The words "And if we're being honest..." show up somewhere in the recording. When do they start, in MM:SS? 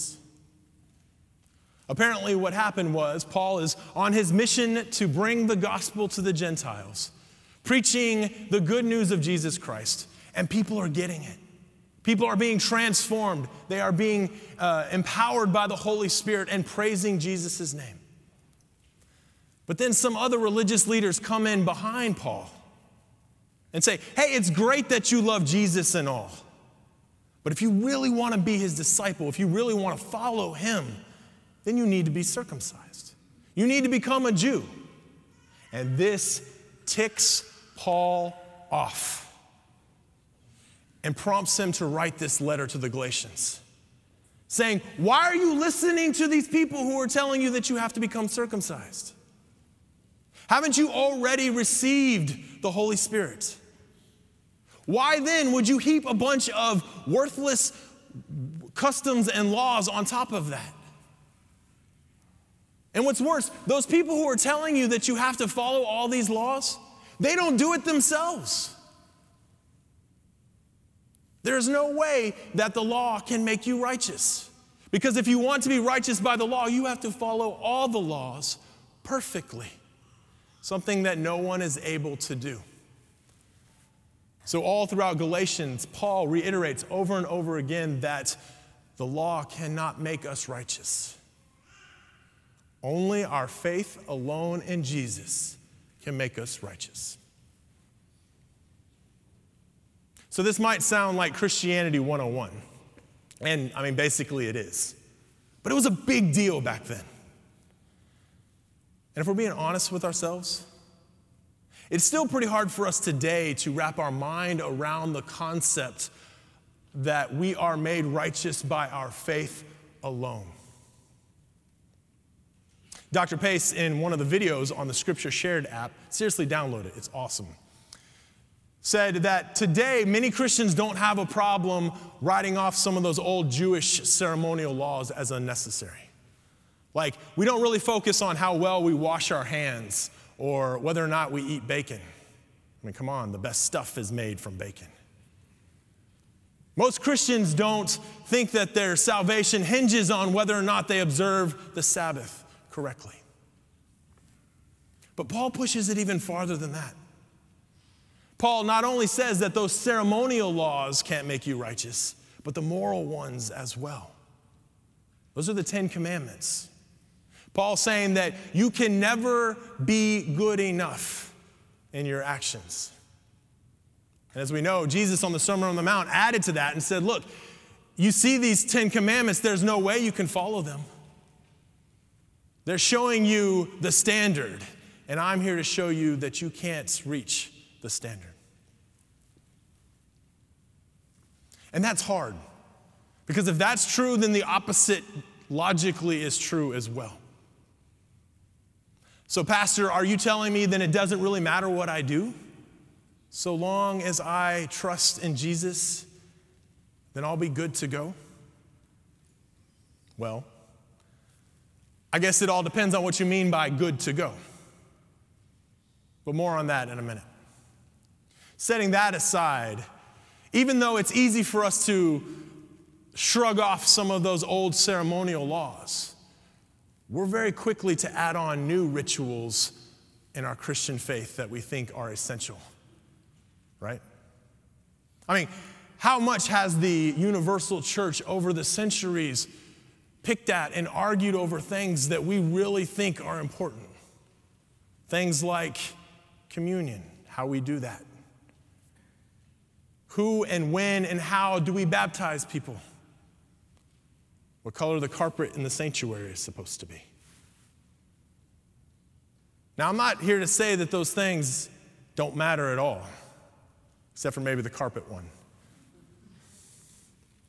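01:49.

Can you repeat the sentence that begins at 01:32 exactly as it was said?
Only our faith alone in Jesus can make us righteous.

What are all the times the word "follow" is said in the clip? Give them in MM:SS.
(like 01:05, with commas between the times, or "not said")
00:30, 01:05, 01:17, 03:00.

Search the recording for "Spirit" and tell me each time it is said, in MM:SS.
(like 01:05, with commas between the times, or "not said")
00:16, 00:52.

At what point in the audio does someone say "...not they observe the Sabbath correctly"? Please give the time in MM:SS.
02:30.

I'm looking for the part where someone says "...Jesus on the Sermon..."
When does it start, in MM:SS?
02:54.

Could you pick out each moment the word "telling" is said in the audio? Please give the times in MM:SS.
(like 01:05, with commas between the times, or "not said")
00:47, 01:04, 03:20.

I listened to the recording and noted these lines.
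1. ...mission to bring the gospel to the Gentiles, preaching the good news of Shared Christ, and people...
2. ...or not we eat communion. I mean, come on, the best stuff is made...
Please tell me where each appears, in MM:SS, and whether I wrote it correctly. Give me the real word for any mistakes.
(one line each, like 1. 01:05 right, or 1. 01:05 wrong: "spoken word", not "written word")
1. 00:04 wrong: "Jesus", not "Shared"
2. 02:21 wrong: "bacon", not "communion".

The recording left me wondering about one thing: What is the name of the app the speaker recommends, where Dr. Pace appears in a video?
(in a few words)
Scripture Shared.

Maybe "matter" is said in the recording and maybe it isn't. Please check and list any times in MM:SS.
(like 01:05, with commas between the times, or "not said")
03:21, 04:22.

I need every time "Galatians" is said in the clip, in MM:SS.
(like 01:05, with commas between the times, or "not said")
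00:42, 01:25.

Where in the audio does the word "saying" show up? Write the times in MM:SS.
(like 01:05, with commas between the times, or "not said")
00:44, 02:47.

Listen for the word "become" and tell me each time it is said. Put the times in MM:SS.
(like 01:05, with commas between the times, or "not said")
00:33, 00:47.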